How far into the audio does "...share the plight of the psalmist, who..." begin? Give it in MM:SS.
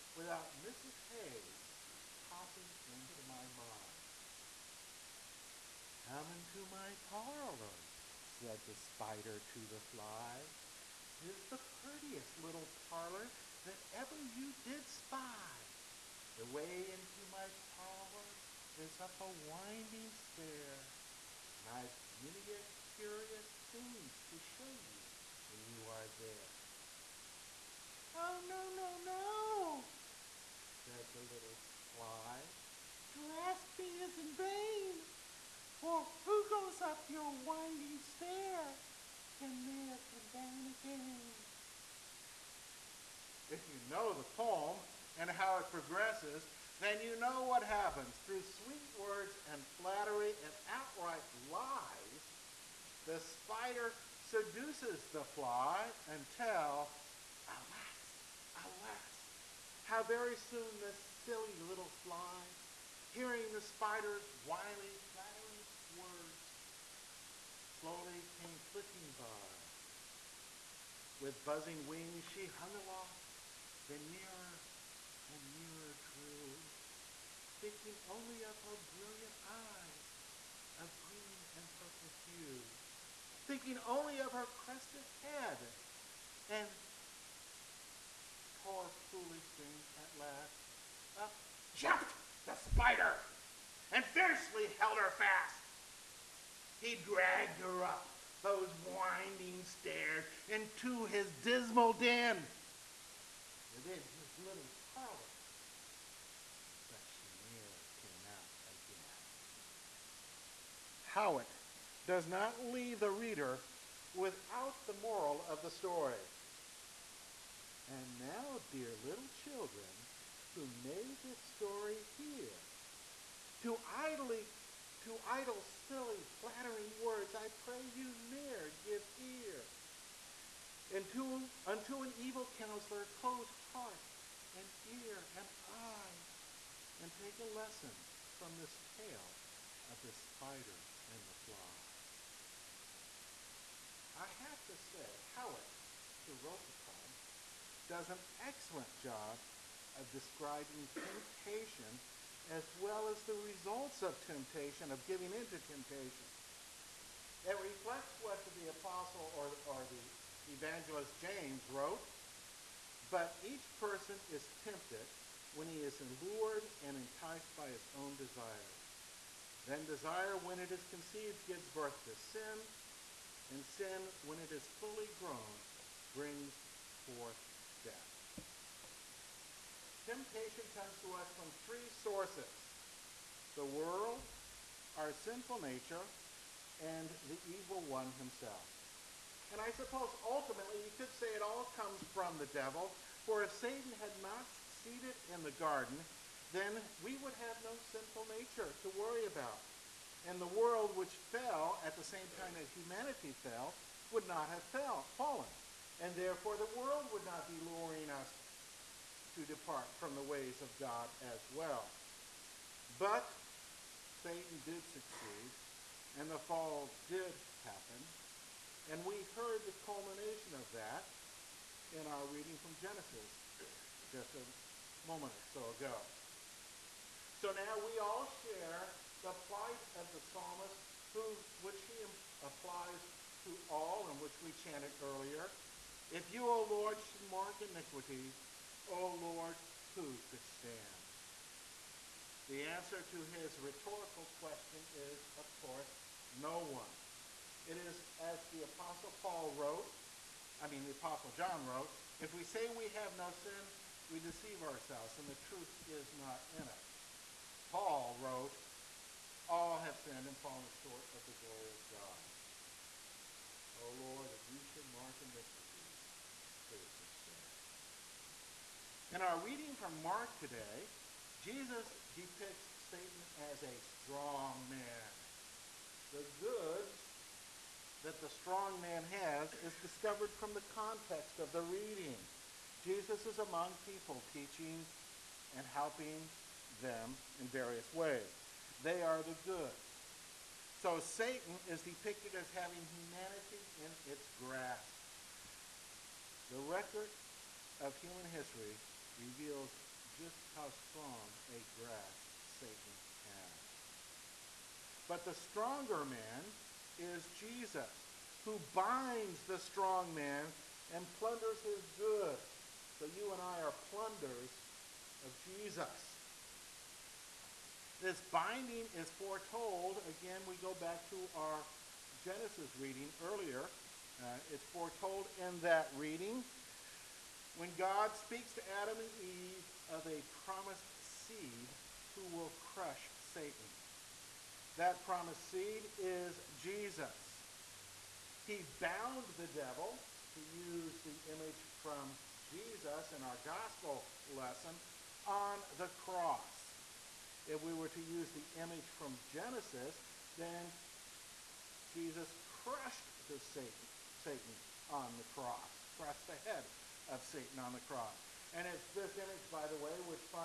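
03:48.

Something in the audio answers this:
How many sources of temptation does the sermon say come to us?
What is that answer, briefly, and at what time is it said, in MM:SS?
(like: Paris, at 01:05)
3, at 03:01.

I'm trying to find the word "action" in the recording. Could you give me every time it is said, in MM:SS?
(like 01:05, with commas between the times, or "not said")
not said.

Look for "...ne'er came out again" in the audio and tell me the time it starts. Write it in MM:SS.
01:47.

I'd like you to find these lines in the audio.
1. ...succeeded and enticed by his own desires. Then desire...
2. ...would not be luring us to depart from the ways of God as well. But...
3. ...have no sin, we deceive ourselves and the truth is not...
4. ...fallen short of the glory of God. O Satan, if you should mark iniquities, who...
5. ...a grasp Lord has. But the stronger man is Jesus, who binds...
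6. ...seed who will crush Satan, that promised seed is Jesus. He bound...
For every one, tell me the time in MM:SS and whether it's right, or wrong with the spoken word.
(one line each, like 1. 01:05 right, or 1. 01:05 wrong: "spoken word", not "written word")
1. 02:46 wrong: "lured", not "succeeded"
2. 03:27 right
3. 04:12 right
4. 04:20 wrong: "Lord", not "Satan"
5. 05:01 wrong: "Satan", not "Lord"
6. 05:30 right.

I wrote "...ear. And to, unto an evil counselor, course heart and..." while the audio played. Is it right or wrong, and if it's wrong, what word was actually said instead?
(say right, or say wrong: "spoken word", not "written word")
wrong: "close", not "course".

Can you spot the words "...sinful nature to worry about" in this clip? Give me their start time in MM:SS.
03:17.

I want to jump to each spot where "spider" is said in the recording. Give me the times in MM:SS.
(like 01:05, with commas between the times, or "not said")
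00:08, 00:53, 01:03, 01:32, 02:20.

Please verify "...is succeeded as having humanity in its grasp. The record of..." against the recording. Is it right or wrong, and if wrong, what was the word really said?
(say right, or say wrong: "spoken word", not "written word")
wrong: "depicted", not "succeeded".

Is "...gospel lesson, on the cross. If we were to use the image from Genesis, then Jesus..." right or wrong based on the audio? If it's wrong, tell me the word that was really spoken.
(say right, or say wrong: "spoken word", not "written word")
right.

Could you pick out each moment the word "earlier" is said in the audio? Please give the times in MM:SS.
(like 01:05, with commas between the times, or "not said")
03:55, 05:23.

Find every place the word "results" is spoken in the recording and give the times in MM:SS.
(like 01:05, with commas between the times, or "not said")
02:33.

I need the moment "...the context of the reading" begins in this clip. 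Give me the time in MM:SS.
04:40.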